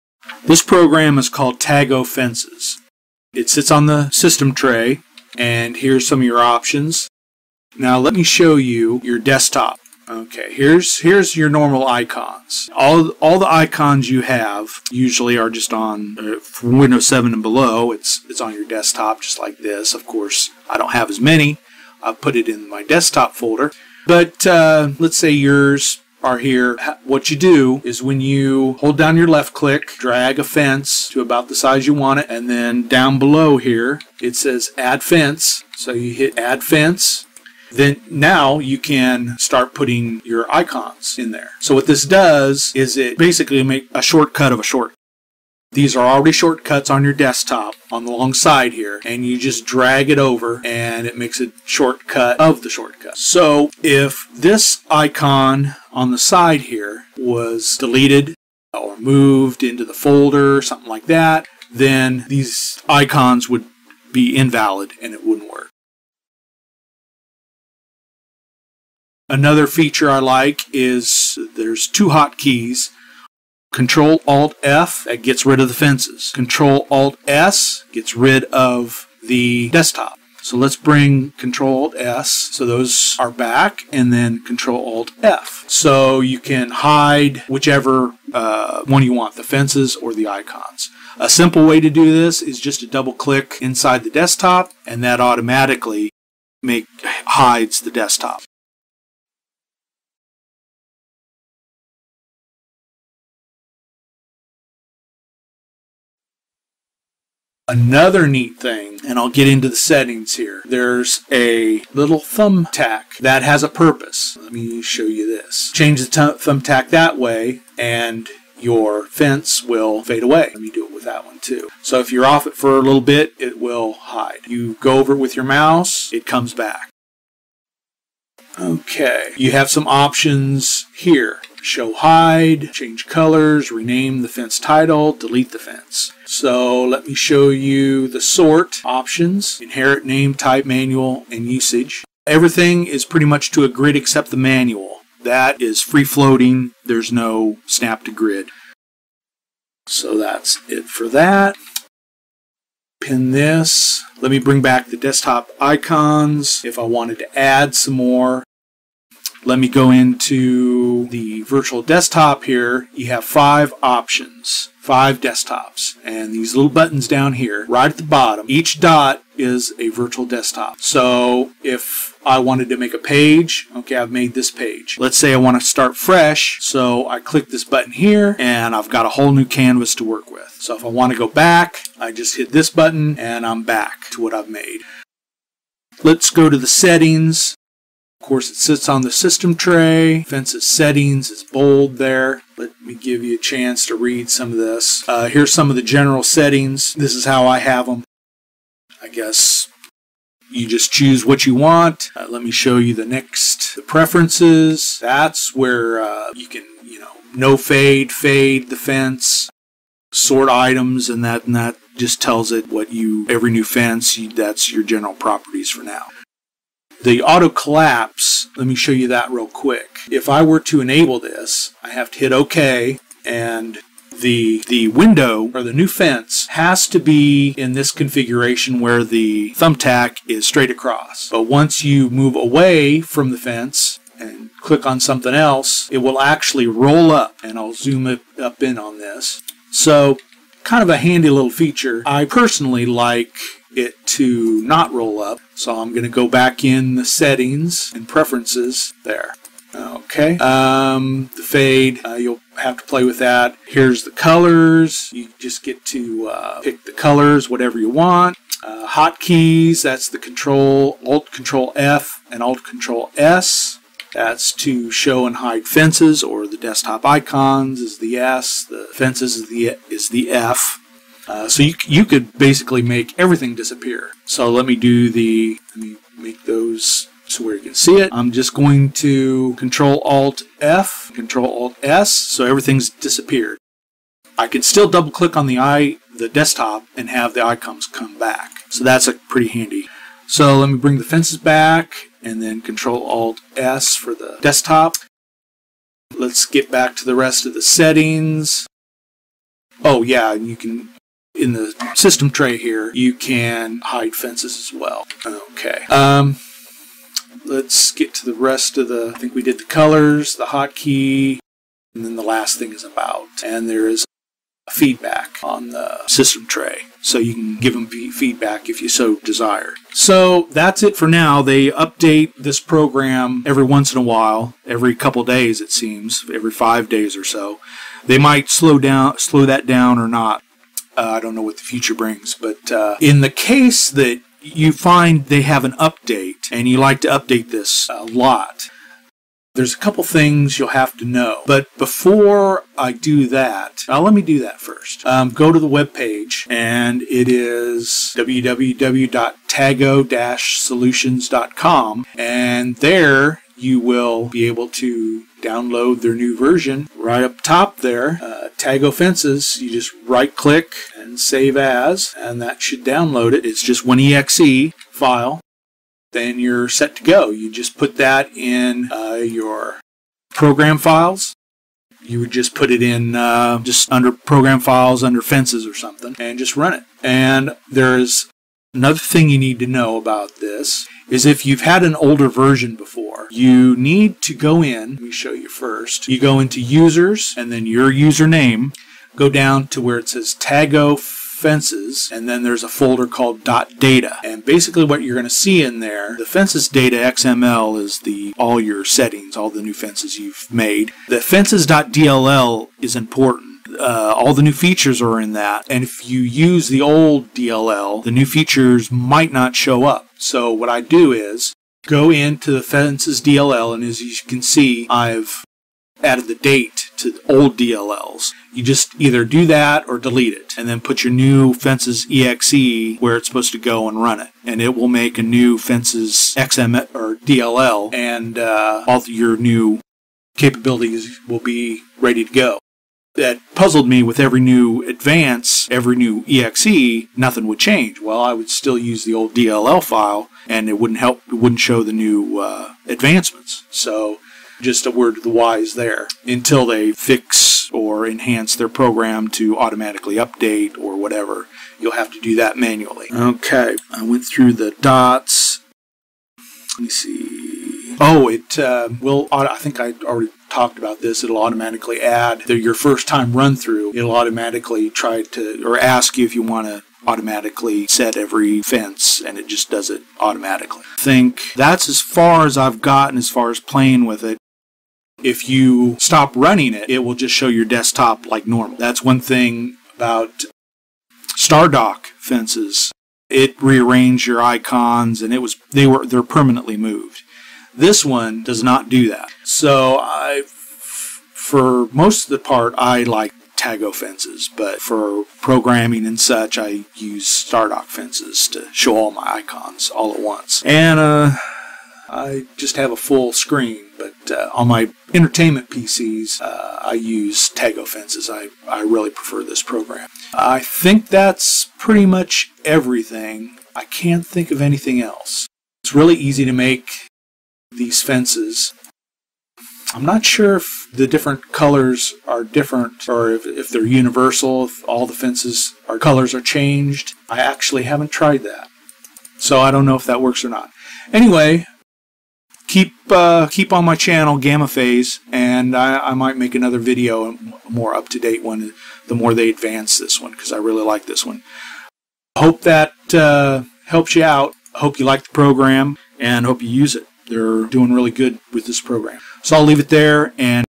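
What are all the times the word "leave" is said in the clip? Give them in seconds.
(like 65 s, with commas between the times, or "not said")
549 s.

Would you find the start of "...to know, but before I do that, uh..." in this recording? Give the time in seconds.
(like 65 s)
340 s.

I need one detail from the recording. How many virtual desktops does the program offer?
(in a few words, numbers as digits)
5.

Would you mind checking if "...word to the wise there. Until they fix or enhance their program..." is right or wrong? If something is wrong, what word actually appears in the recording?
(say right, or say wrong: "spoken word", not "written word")
right.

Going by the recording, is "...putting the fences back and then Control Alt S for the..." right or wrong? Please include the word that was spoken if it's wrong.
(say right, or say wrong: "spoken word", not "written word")
wrong: "bring", not "putting".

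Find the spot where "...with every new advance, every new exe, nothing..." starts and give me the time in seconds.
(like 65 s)
434 s.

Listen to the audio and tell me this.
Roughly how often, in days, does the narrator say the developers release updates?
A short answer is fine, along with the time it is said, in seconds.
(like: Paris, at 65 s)
5, at 326 s.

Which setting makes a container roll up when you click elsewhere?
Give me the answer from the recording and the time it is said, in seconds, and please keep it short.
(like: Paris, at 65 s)
Auto collapse, at 217 s.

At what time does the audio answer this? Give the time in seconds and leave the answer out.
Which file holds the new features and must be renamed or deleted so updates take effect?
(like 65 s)
401 s.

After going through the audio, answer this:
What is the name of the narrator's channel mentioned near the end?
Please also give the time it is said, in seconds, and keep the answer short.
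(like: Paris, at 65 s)
Gamma Phase, at 534 s.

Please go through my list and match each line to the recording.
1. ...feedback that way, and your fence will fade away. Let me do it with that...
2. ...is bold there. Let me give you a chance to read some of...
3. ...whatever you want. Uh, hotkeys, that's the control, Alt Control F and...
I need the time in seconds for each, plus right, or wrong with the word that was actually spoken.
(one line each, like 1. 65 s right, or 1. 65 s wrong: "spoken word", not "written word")
1. 116 s wrong: "thumbtack", not "feedback"
2. 191 s right
3. 257 s right.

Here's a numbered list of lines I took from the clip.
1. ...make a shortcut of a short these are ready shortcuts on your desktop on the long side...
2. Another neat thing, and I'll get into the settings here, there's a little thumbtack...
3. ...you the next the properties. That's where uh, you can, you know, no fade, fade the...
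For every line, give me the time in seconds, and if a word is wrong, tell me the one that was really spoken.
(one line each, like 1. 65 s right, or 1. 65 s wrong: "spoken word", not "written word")
1. 43 s wrong: "already", not "ready"
2. 107 s right
3. 202 s wrong: "preferences", not "properties".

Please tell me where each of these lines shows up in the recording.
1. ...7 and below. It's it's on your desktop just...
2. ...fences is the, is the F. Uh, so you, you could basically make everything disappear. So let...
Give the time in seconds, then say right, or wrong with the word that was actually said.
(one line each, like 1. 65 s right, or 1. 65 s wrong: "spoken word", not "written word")
1. 17 s right
2. 268 s right.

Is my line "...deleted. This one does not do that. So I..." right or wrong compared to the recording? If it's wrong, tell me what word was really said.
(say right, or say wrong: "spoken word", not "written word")
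wrong: "moved", not "deleted".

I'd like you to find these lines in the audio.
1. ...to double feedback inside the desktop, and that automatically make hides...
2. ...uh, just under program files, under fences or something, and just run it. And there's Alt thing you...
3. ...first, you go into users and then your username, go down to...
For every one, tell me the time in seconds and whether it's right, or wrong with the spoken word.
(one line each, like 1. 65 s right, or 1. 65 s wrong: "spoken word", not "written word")
1. 92 s wrong: "click", not "feedback"
2. 373 s wrong: "Another", not "Alt"
3. 385 s right.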